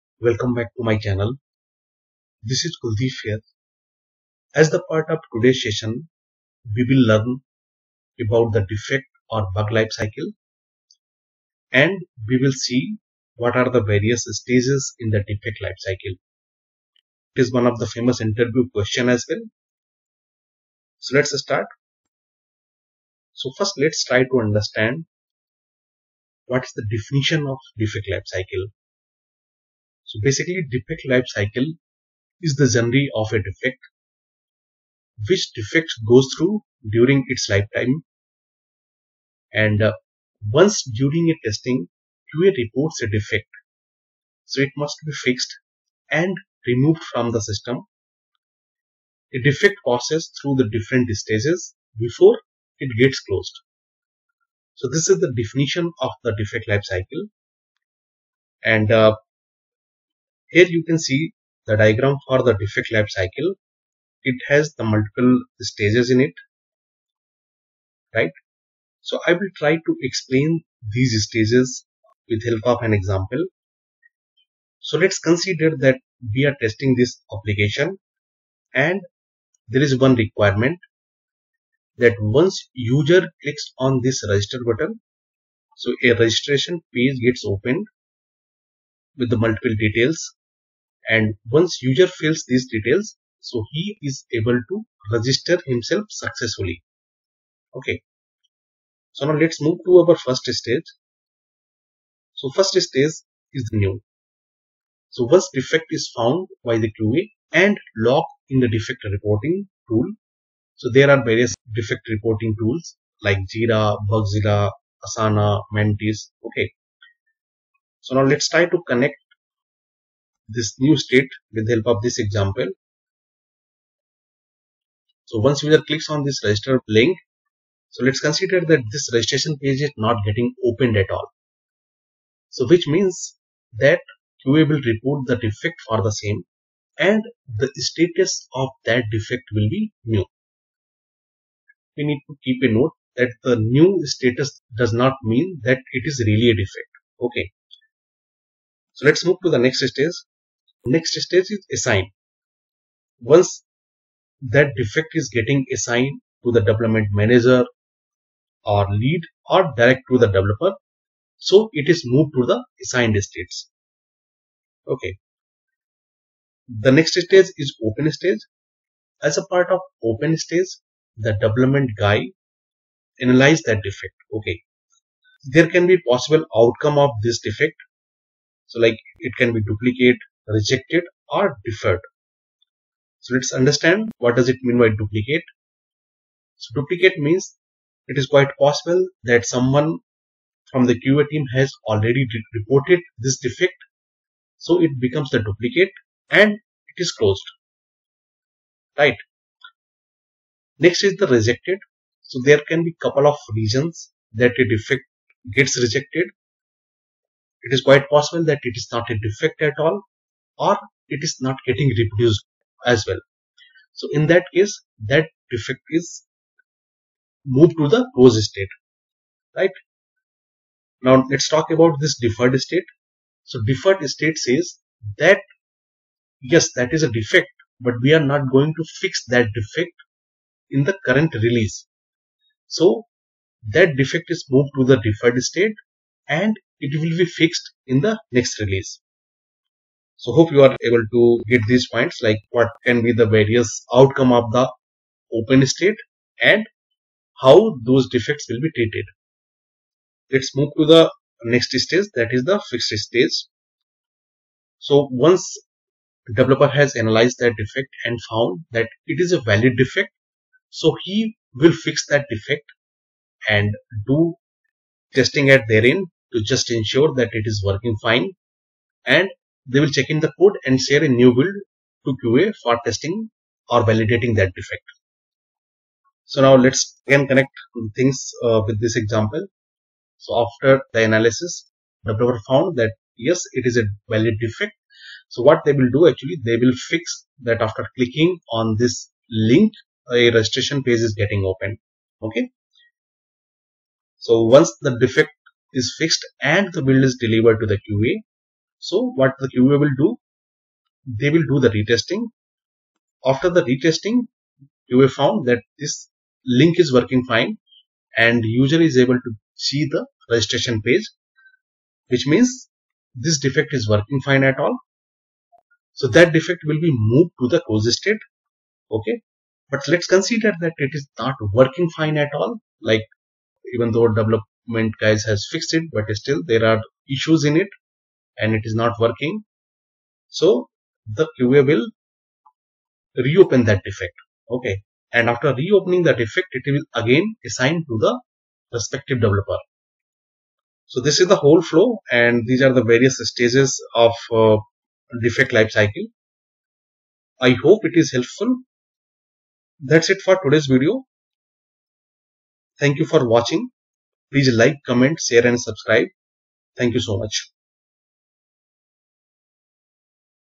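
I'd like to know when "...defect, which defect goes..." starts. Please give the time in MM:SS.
00:33.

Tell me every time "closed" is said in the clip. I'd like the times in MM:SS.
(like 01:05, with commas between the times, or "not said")
00:53, 03:17, 03:38, 05:17.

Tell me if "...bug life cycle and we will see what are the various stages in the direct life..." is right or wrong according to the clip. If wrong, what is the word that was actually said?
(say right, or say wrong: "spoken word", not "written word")
wrong: "defect", not "direct".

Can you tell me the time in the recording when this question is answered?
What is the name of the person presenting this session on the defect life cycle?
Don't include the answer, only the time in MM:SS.
00:02.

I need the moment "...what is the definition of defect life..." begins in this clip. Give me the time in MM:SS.
00:26.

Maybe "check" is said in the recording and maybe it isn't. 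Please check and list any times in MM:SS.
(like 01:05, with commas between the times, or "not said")
04:29.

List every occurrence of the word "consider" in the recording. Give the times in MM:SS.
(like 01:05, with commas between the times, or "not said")
01:15, 02:08, 05:20.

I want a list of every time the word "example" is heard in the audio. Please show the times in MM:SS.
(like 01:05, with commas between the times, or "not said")
01:12, 02:02, 04:38.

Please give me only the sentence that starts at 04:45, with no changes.
So what they will do actually, they will fix that after clicking on this link, a registration page is getting open.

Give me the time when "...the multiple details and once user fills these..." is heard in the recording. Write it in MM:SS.
01:29.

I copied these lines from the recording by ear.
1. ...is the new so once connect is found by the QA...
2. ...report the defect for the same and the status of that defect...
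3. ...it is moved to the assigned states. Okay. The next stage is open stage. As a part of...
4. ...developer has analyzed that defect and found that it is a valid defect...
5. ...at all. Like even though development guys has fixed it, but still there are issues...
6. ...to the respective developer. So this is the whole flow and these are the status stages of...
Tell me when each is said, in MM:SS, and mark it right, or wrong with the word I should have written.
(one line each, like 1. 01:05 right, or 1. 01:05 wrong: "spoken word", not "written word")
1. 01:43 wrong: "defect", not "connect"
2. 02:14 right
3. 02:41 right
4. 04:16 right
5. 05:22 right
6. 05:37 wrong: "various", not "status".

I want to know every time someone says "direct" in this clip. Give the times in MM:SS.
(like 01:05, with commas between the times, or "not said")
02:39.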